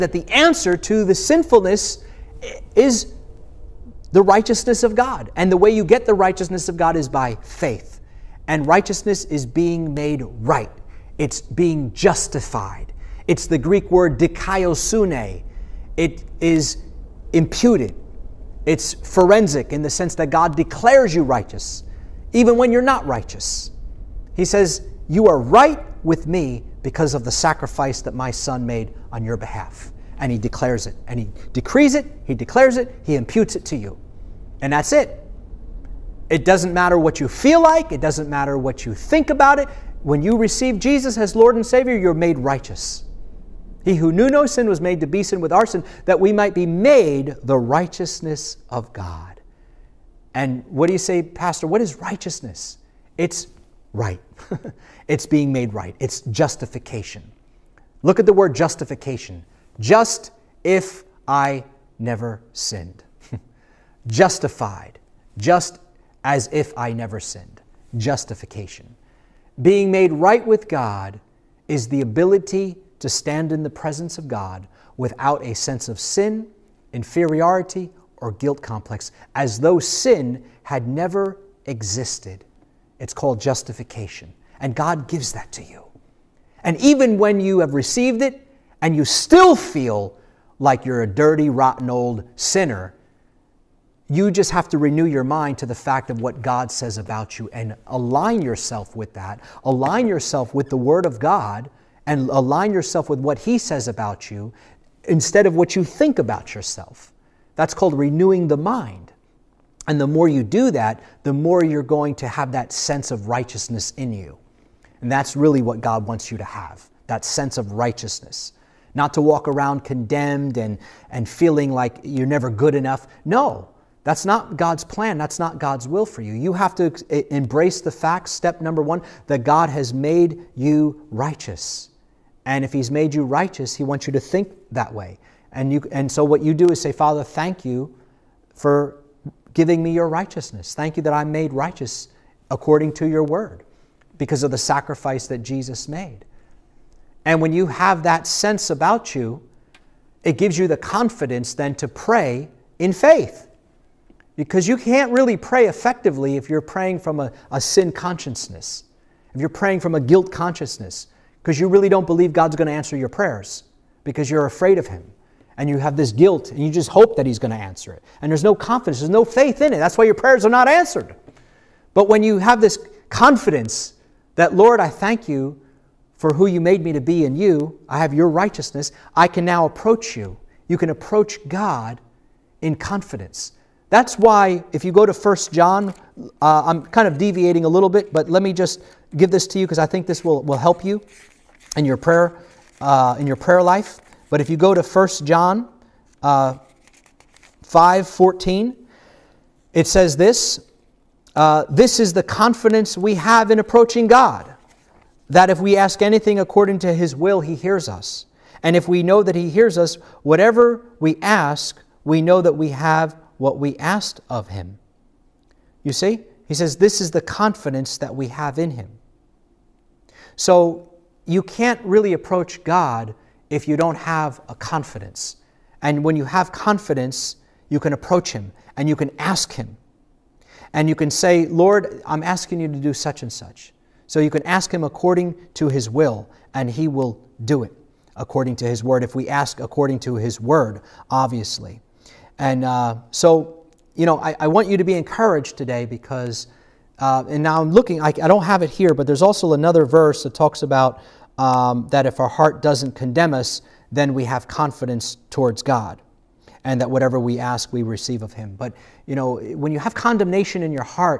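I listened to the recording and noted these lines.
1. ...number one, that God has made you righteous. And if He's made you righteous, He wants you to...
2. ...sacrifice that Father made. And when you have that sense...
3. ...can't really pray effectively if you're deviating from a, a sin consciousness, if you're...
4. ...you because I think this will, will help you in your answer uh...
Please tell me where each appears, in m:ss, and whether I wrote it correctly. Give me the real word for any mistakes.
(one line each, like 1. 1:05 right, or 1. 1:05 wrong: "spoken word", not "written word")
1. 2:08 right
2. 2:24 wrong: "Jesus", not "Father"
3. 2:34 wrong: "praying", not "deviating"
4. 3:09 wrong: "prayer", not "answer".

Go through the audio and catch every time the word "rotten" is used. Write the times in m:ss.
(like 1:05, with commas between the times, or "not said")
1:31.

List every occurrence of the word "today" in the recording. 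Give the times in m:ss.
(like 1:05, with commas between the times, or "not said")
4:05.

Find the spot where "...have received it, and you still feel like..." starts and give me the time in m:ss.
1:27.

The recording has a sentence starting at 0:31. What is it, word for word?
And he decrees it, he declares it, he imputes it to you.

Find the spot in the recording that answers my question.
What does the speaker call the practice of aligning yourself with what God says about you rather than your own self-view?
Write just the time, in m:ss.
1:47.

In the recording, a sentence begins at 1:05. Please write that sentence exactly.
Just as if I never sinned.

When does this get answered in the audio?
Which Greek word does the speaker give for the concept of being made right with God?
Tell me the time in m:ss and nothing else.
0:14.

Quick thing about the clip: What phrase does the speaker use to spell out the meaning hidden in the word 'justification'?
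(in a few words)
Just if I never sinned.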